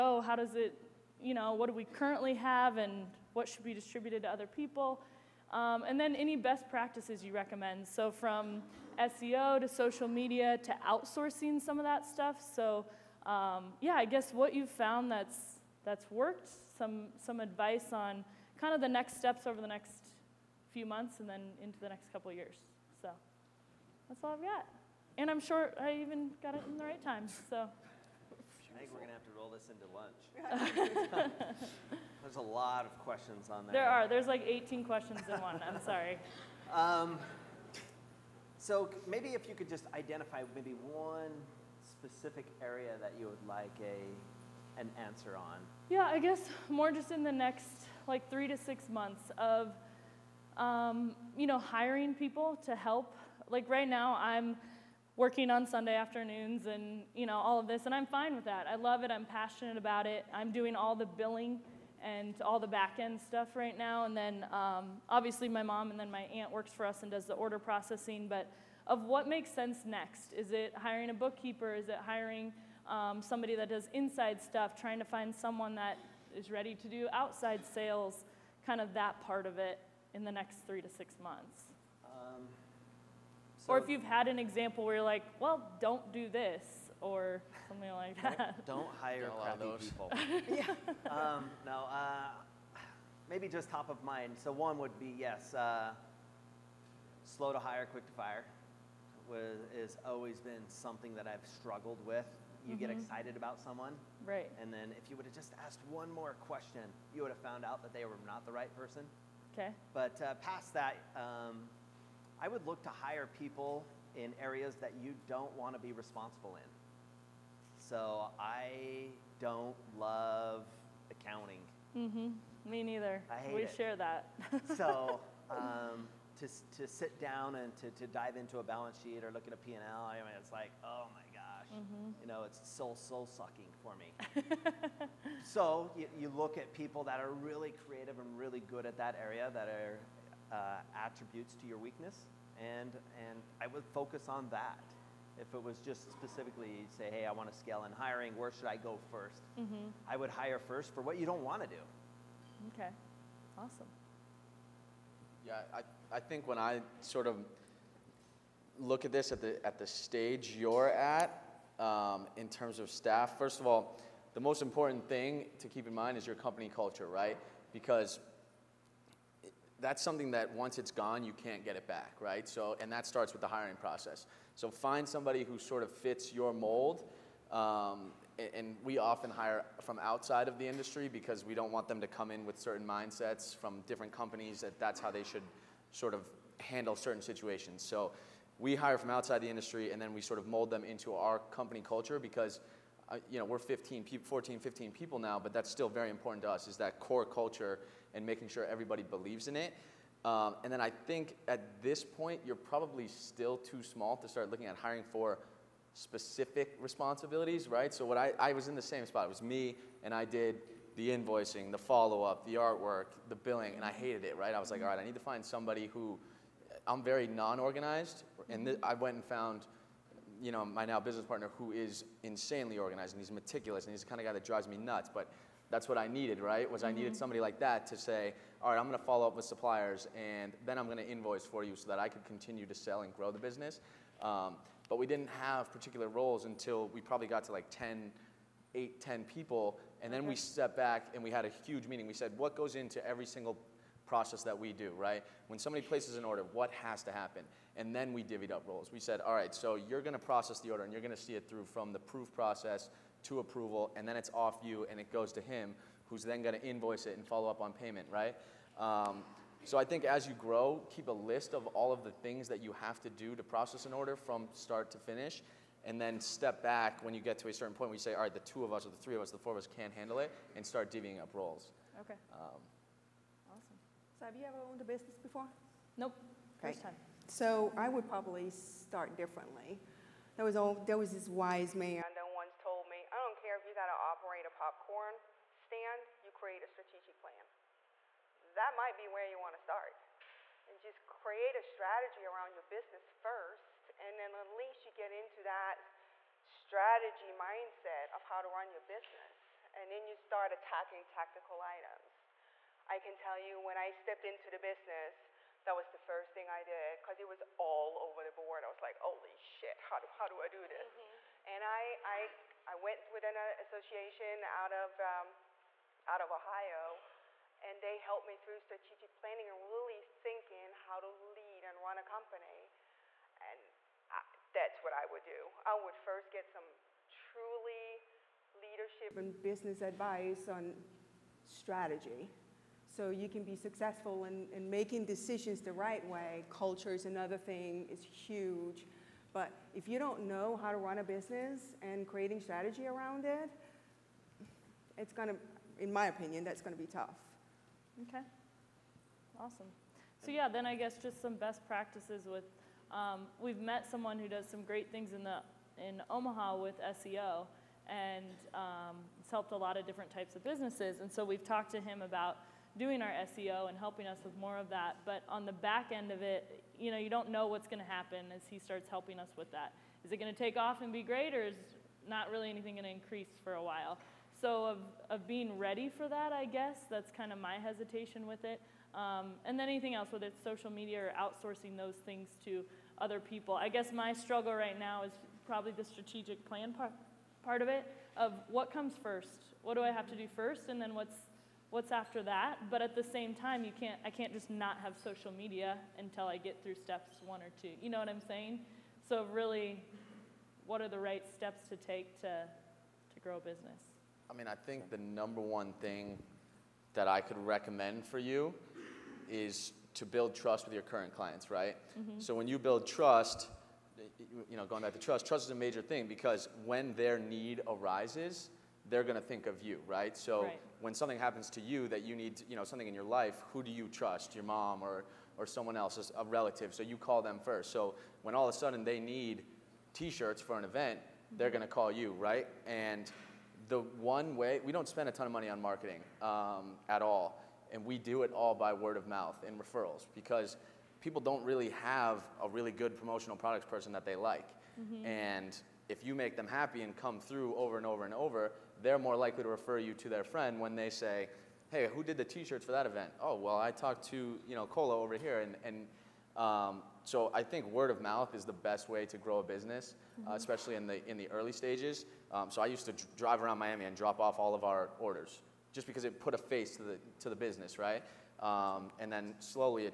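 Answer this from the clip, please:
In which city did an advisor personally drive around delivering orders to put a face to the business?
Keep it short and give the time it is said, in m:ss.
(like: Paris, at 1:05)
Miami, at 7:43.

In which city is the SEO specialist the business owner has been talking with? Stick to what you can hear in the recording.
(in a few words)
Omaha.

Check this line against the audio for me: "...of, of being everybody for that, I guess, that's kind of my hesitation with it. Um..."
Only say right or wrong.
wrong.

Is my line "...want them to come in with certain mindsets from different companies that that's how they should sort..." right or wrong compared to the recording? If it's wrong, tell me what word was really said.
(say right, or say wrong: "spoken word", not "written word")
right.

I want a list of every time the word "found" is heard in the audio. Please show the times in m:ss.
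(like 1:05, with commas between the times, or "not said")
0:14, 1:47, 3:39.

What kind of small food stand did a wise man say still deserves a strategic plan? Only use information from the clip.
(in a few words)
popcorn stand.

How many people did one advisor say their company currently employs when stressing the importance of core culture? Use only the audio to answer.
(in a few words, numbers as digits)
15.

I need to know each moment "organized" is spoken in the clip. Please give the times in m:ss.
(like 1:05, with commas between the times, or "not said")
3:37, 3:42.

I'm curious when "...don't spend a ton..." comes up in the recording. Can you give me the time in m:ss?
7:14.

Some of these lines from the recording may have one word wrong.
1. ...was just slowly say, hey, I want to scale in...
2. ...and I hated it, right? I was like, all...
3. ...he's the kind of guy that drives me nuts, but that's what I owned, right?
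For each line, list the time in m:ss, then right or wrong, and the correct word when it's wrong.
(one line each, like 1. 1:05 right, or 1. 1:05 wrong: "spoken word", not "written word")
1. 2:25 wrong: "specifically", not "slowly"
2. 3:33 right
3. 3:43 wrong: "needed", not "owned".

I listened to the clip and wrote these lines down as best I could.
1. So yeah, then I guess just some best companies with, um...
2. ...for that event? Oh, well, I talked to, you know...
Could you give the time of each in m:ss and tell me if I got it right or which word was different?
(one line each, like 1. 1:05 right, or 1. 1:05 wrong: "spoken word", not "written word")
1. 5:50 wrong: "practices", not "companies"
2. 7:32 right.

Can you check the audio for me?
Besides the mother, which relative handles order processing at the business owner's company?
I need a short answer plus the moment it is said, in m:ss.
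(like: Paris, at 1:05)
aunt, at 1:06.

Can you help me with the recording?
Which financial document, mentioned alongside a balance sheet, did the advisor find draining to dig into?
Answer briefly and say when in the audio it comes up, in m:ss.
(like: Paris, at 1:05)
P&L, at 2:09.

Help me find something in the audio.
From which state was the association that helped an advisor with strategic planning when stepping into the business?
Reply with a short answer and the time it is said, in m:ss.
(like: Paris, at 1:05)
Ohio, at 5:16.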